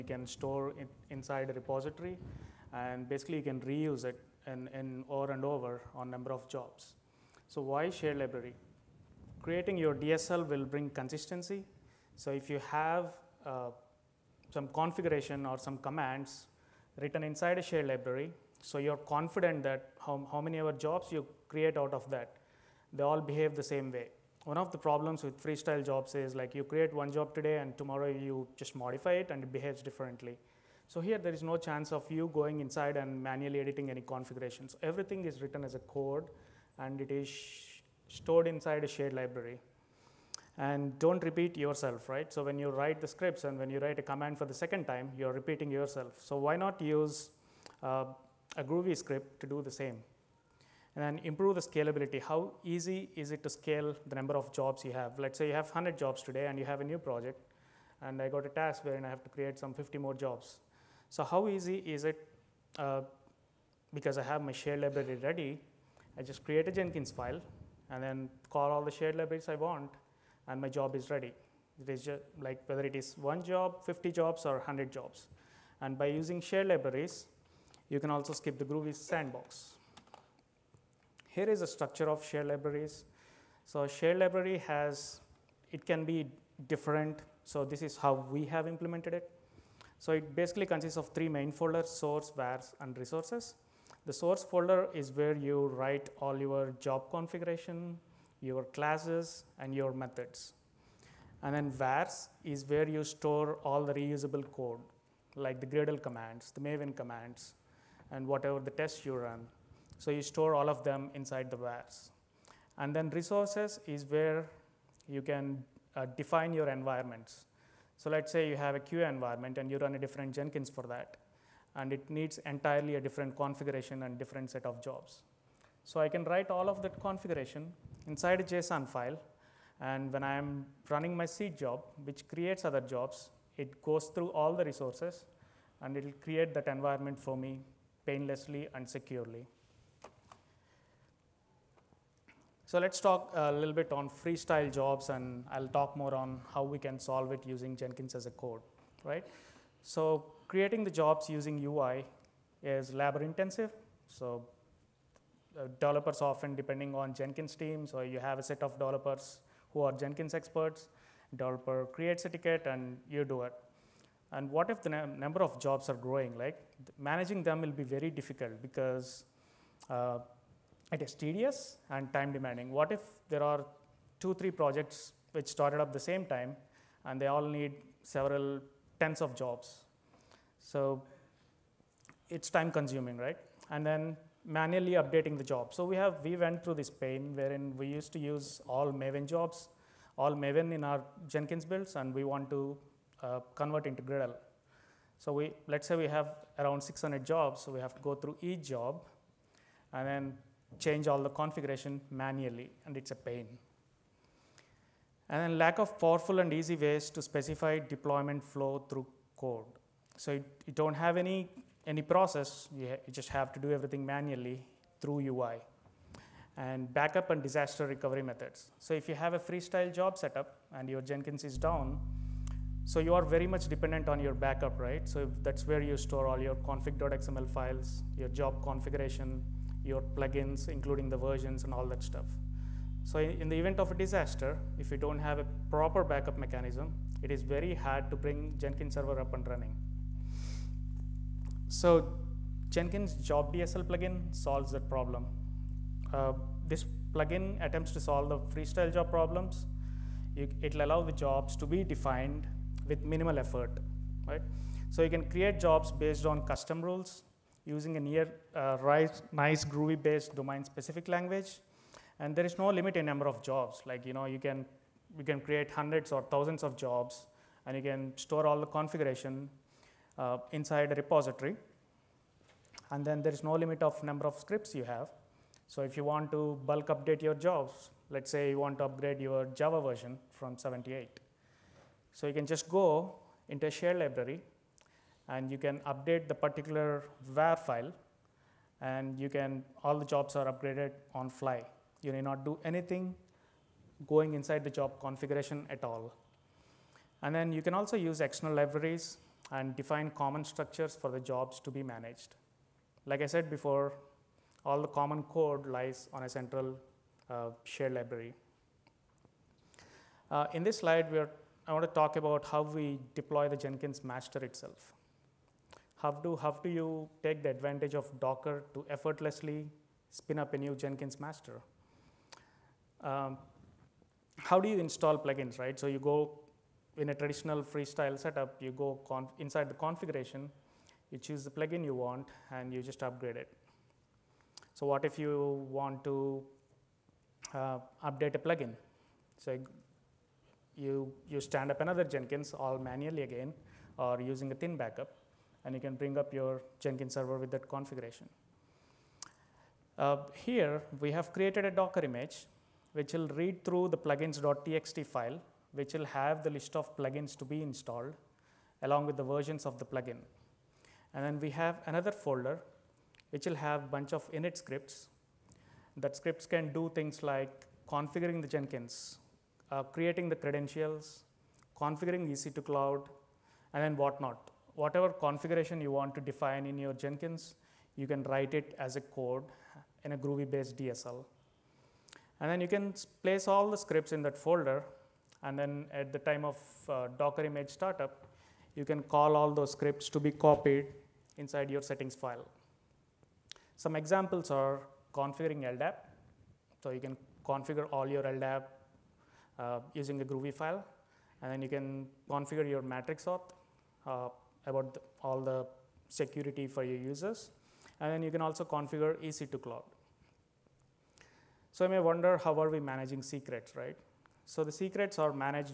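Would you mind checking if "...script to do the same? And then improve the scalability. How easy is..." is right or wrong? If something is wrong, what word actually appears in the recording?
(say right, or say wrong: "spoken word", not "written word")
right.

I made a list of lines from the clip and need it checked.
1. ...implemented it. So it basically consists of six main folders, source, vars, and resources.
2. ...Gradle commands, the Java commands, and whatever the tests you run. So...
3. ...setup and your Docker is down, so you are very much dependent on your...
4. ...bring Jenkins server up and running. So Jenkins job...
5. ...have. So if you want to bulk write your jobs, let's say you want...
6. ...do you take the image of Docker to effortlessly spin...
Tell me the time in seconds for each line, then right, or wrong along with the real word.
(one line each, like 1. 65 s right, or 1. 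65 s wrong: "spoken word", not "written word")
1. 88 s wrong: "three", not "six"
2. 105 s wrong: "Maven", not "Java"
3. 220 s wrong: "Jenkins", not "Docker"
4. 238 s right
5. 274 s wrong: "update", not "write"
6. 316 s wrong: "advantage", not "image".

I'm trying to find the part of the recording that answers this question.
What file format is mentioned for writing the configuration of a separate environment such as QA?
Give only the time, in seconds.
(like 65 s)
128 s.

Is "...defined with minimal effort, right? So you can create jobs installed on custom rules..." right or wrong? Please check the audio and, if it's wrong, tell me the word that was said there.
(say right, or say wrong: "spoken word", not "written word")
wrong: "based", not "installed".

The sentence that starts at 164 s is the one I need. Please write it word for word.
And what if the number of jobs are growing?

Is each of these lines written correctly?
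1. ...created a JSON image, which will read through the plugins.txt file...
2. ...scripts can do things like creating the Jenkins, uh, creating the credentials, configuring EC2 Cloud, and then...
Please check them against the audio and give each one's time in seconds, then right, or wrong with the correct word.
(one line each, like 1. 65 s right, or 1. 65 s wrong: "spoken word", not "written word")
1. 351 s wrong: "Docker", not "JSON"
2. 366 s wrong: "configuring", not "creating".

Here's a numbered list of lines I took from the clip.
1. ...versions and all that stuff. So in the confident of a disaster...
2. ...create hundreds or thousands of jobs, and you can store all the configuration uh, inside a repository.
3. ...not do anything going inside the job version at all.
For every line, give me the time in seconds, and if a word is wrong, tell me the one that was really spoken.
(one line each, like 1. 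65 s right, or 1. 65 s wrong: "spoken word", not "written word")
1. 231 s wrong: "event", not "confident"
2. 265 s right
3. 292 s wrong: "configuration", not "version".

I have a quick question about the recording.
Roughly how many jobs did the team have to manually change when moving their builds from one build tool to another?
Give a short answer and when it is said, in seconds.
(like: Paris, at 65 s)
600, at 196 s.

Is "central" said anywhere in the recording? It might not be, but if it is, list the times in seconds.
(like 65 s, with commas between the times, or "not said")
306 s.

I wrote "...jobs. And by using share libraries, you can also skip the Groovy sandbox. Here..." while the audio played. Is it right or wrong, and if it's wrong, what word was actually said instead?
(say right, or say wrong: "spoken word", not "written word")
right.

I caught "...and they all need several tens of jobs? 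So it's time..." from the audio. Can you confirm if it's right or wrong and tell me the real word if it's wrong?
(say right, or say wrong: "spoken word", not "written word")
right.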